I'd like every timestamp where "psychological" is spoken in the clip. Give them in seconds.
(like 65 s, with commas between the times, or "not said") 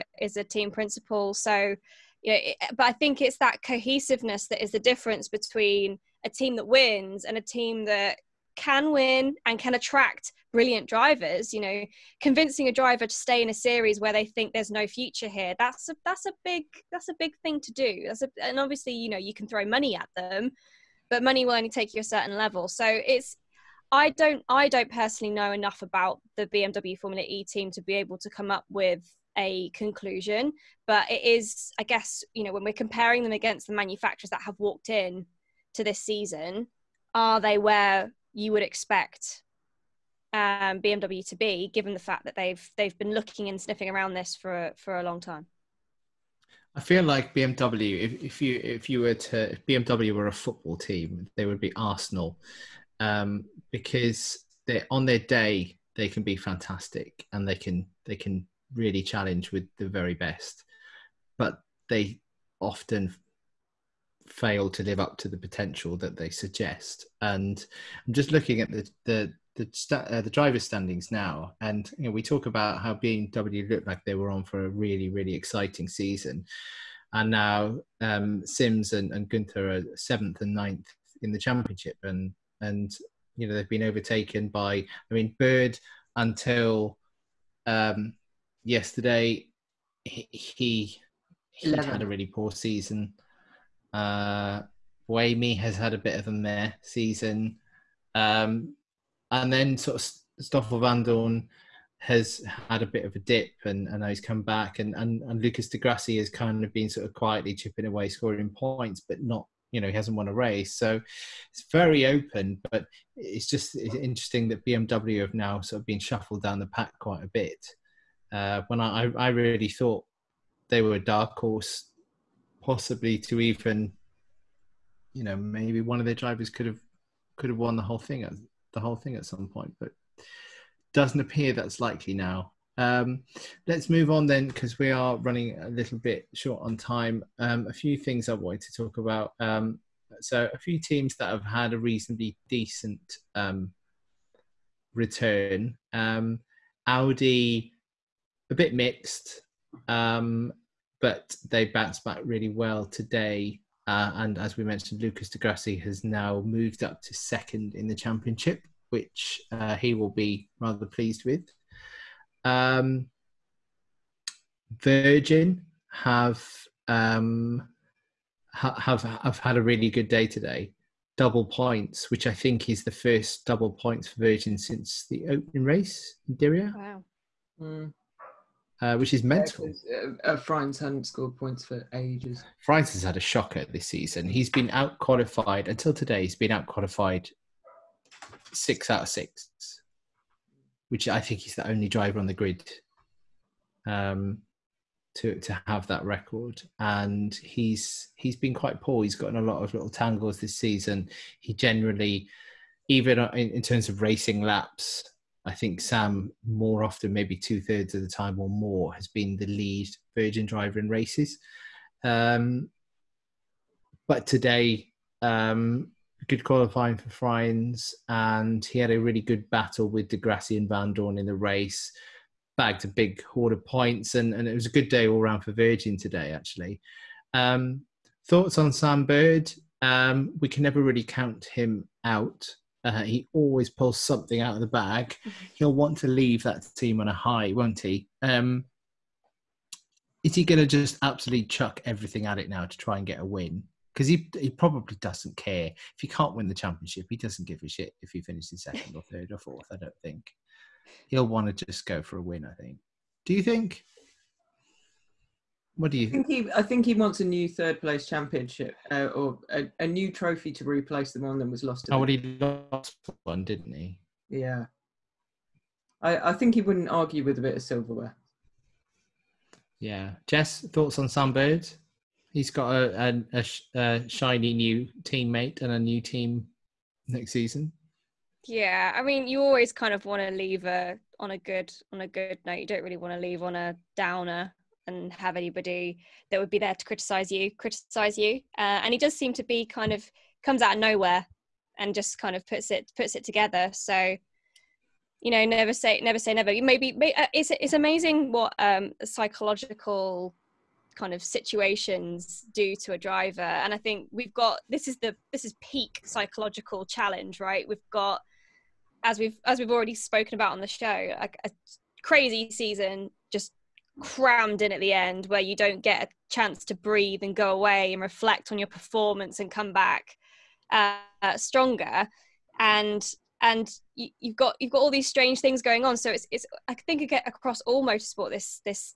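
299 s, 306 s.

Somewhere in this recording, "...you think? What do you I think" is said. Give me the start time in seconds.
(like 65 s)
253 s.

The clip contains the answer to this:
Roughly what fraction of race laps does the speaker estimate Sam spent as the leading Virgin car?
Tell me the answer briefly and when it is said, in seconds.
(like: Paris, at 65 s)
two thirds, at 207 s.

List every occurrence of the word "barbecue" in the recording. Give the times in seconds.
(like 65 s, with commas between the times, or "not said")
not said.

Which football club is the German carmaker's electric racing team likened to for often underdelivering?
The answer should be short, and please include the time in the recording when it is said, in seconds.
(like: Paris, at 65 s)
Arsenal, at 51 s.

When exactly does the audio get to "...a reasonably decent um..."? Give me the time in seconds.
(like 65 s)
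141 s.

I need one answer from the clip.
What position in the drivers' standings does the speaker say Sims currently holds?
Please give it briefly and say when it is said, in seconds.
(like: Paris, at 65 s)
7th, at 79 s.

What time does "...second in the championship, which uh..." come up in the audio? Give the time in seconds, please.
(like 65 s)
157 s.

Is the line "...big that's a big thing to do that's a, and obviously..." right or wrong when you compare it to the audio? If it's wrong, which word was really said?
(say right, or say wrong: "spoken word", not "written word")
right.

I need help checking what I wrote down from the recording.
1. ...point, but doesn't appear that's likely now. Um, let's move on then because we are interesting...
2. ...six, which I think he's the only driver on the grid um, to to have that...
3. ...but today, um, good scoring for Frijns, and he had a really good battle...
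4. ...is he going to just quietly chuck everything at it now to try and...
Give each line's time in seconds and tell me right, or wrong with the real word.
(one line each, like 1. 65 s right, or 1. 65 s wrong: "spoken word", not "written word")
1. 129 s wrong: "running", not "interesting"
2. 189 s right
3. 214 s wrong: "qualifying", not "scoring"
4. 240 s wrong: "absolutely", not "quietly".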